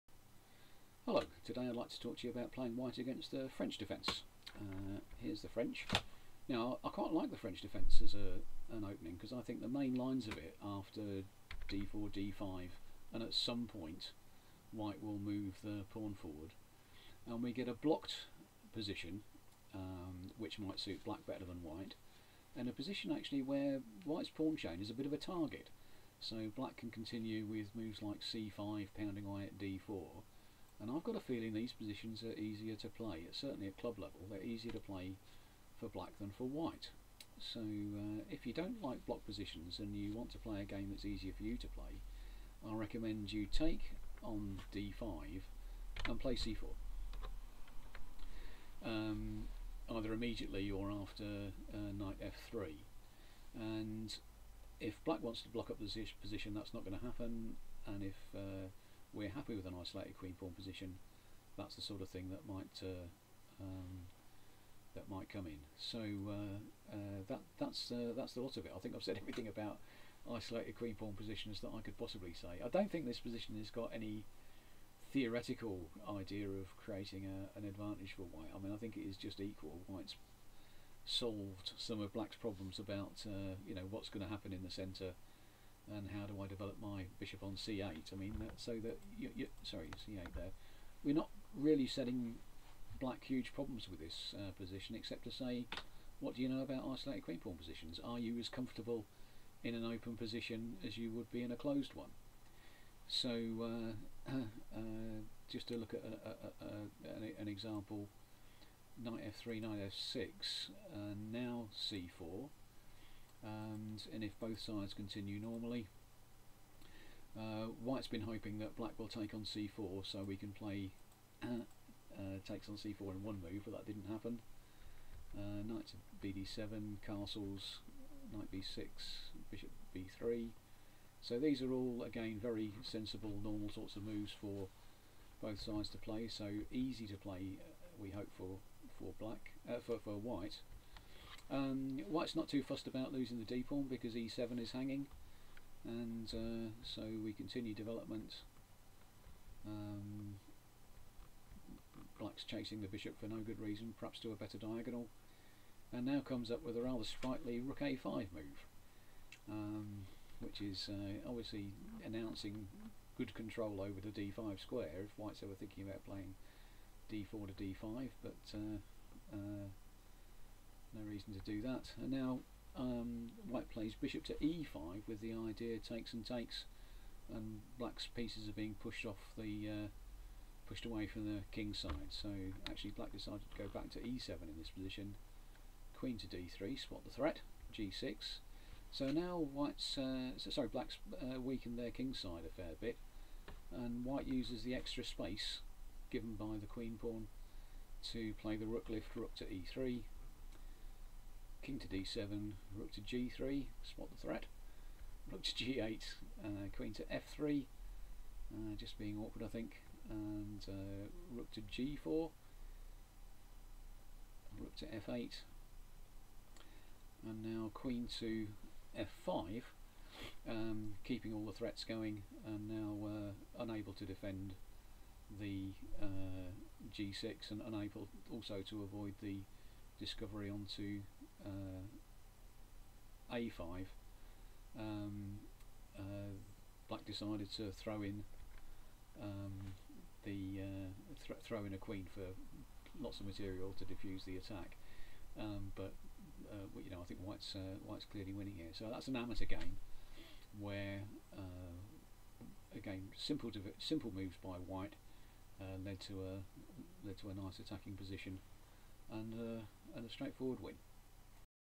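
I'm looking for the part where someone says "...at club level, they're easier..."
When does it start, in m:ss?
0:33.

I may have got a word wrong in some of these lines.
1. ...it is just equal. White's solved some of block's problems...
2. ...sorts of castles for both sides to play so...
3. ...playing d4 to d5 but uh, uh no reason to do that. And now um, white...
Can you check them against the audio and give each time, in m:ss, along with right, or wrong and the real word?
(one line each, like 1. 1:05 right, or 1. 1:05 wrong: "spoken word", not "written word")
1. 1:18 wrong: "black", not "block"
2. 2:13 wrong: "moves", not "castles"
3. 2:46 right.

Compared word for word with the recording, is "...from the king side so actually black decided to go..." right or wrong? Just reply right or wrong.
right.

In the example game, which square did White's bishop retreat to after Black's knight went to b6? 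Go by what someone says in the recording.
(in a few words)
b3.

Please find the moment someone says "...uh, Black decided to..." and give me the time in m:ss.
3:55.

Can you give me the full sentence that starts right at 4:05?
Um, but uh, you know, I think White's uh, White's clearly winning here.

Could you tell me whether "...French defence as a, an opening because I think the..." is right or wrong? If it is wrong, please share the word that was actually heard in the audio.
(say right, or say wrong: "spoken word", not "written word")
right.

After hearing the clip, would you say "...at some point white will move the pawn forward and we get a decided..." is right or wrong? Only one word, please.
wrong.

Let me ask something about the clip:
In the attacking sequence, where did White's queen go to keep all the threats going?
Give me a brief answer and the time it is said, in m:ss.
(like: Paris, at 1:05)
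f5, at 3:37.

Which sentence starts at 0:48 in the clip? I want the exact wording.
Um, either immediately or after uh, knight f3.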